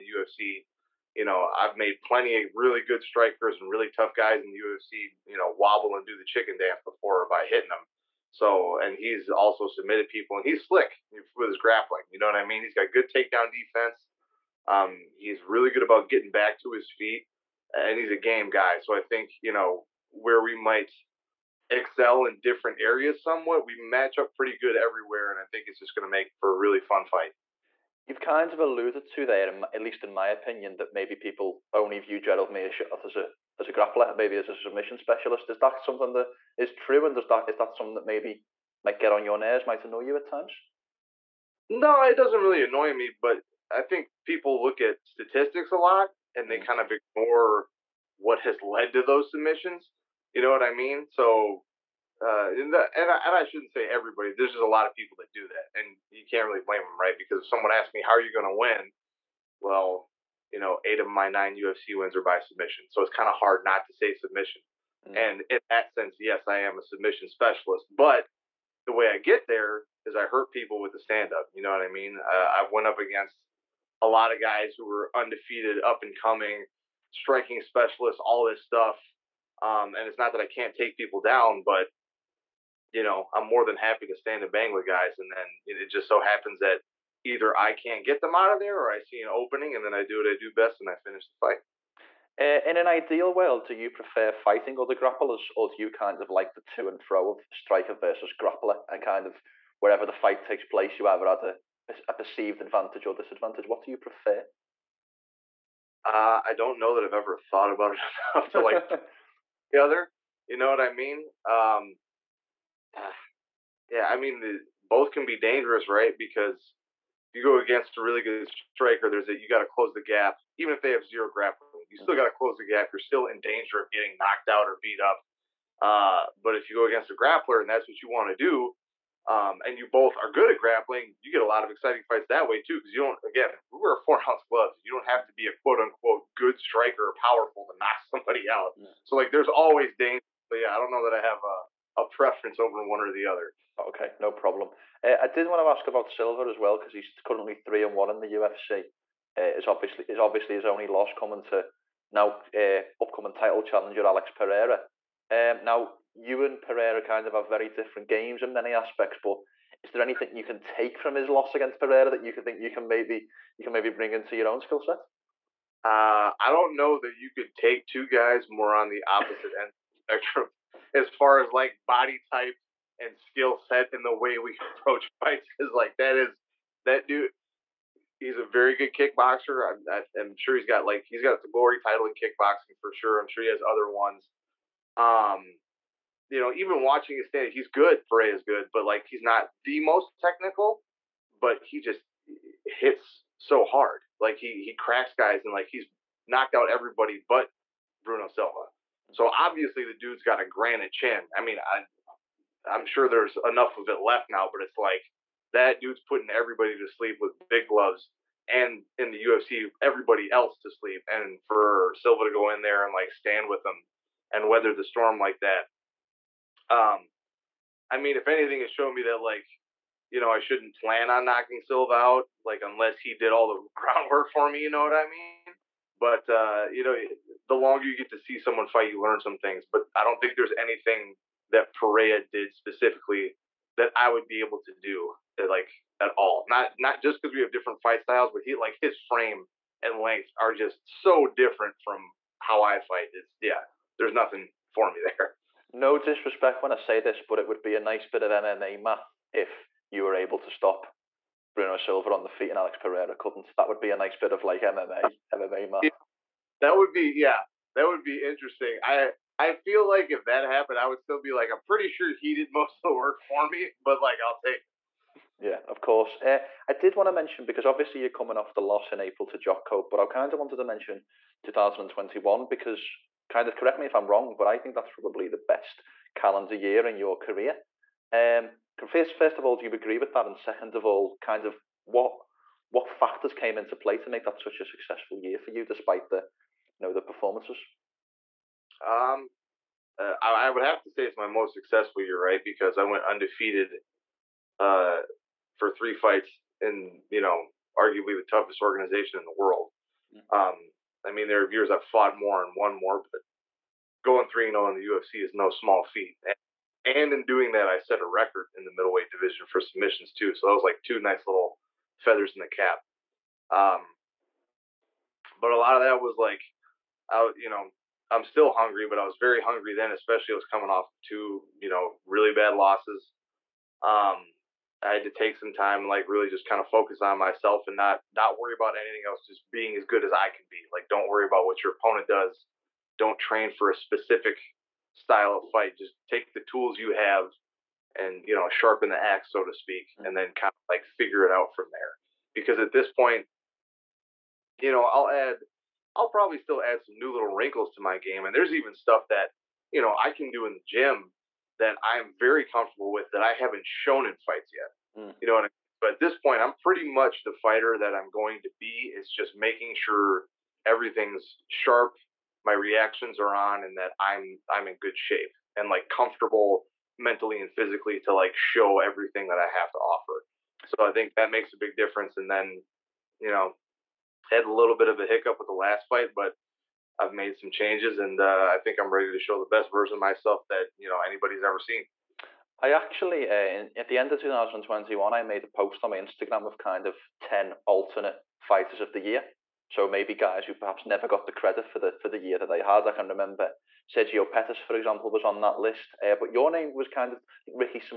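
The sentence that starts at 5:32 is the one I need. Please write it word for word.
Don't train for a specific style of fight.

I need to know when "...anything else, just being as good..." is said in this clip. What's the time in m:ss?
5:28.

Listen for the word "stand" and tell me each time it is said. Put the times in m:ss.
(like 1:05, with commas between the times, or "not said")
1:10, 1:24, 3:07, 3:33.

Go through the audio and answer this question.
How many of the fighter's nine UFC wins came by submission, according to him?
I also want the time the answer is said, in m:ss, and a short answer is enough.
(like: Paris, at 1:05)
8, at 1:00.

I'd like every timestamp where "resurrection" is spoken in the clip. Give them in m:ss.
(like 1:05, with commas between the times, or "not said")
not said.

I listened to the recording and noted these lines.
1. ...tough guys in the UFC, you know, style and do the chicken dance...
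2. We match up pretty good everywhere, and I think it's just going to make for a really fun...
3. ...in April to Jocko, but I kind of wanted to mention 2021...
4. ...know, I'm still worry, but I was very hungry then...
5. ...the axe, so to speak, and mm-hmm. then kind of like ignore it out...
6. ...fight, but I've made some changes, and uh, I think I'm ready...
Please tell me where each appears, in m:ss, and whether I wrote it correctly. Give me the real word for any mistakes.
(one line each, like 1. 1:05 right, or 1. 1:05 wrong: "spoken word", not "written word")
1. 0:03 wrong: "wobble", not "style"
2. 0:23 right
3. 4:28 right
4. 5:17 wrong: "hungry", not "worry"
5. 5:38 wrong: "figure", not "ignore"
6. 6:15 right.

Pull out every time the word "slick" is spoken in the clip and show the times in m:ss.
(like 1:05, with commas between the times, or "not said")
0:10.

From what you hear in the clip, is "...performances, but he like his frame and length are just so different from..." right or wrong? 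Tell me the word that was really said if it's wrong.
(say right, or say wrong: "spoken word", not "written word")
wrong: "styles", not "performances".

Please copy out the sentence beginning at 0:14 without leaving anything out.
Um, he's really good about getting back to his feet, and he's a game guy.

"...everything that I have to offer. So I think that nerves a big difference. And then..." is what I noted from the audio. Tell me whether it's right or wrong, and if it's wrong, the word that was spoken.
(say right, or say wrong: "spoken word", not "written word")
wrong: "makes", not "nerves".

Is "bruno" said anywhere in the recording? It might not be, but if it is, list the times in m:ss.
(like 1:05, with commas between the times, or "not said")
3:18, 4:11.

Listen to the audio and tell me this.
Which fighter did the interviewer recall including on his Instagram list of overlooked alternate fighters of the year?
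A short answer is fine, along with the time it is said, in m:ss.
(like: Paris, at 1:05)
Sergio Pettis, at 6:33.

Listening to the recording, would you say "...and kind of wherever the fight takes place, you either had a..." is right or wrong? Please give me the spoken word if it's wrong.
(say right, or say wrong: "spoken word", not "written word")
right.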